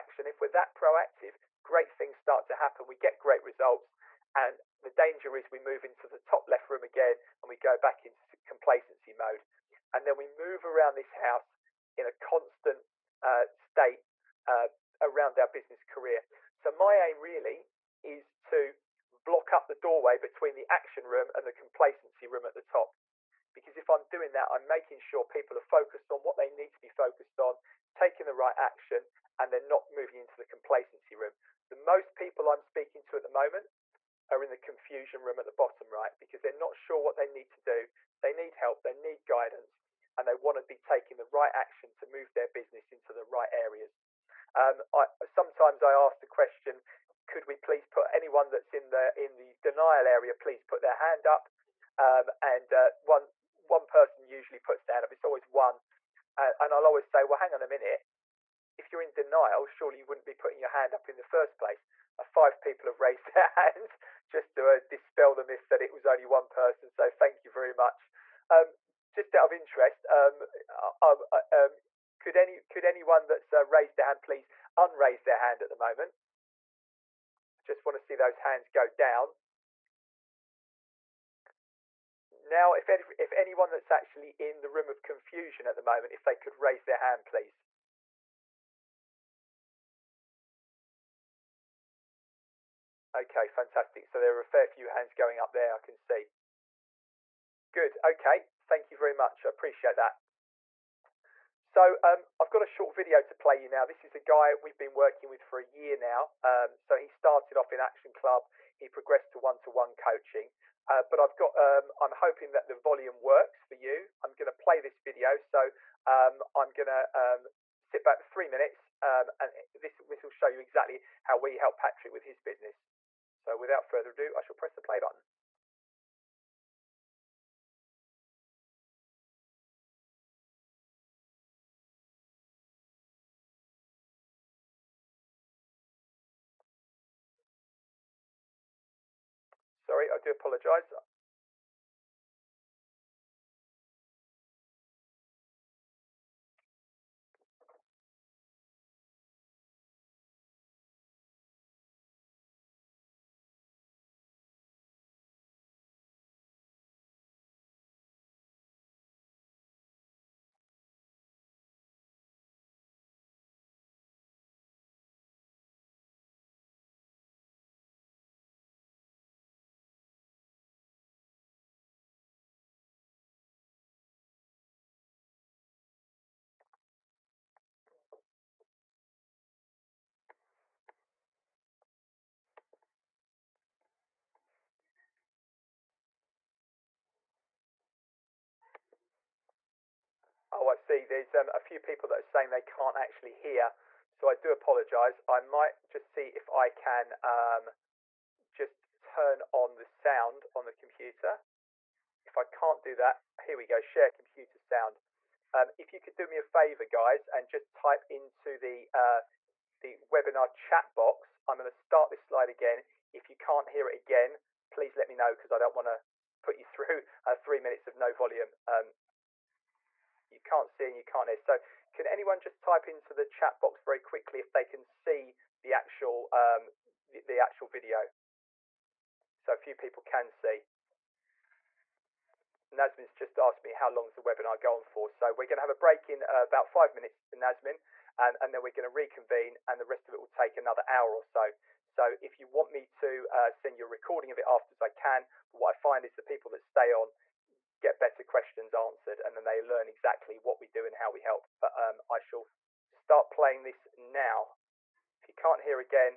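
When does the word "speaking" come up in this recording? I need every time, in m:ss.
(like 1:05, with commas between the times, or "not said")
0:32.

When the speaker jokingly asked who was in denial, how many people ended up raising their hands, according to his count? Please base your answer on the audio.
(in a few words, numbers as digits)
5.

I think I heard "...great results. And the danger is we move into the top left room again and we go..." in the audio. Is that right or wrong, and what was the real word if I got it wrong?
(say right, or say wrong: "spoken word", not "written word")
right.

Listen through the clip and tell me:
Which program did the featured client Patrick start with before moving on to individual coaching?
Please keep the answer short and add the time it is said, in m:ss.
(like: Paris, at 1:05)
Action Club, at 1:47.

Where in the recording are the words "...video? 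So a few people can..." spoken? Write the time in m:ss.
3:47.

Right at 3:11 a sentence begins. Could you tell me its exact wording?
There's um, a few people that are saying they can't actually hear.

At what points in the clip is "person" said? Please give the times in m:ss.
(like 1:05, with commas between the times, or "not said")
0:53, 1:06.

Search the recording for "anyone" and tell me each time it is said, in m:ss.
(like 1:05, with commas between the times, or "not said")
0:48, 1:12, 1:23, 3:42.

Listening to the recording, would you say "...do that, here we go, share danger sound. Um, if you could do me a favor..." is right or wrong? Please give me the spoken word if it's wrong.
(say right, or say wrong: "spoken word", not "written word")
wrong: "computer", not "danger".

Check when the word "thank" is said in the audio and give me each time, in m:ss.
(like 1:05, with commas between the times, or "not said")
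1:07, 1:38.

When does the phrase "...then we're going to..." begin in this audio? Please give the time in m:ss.
3:58.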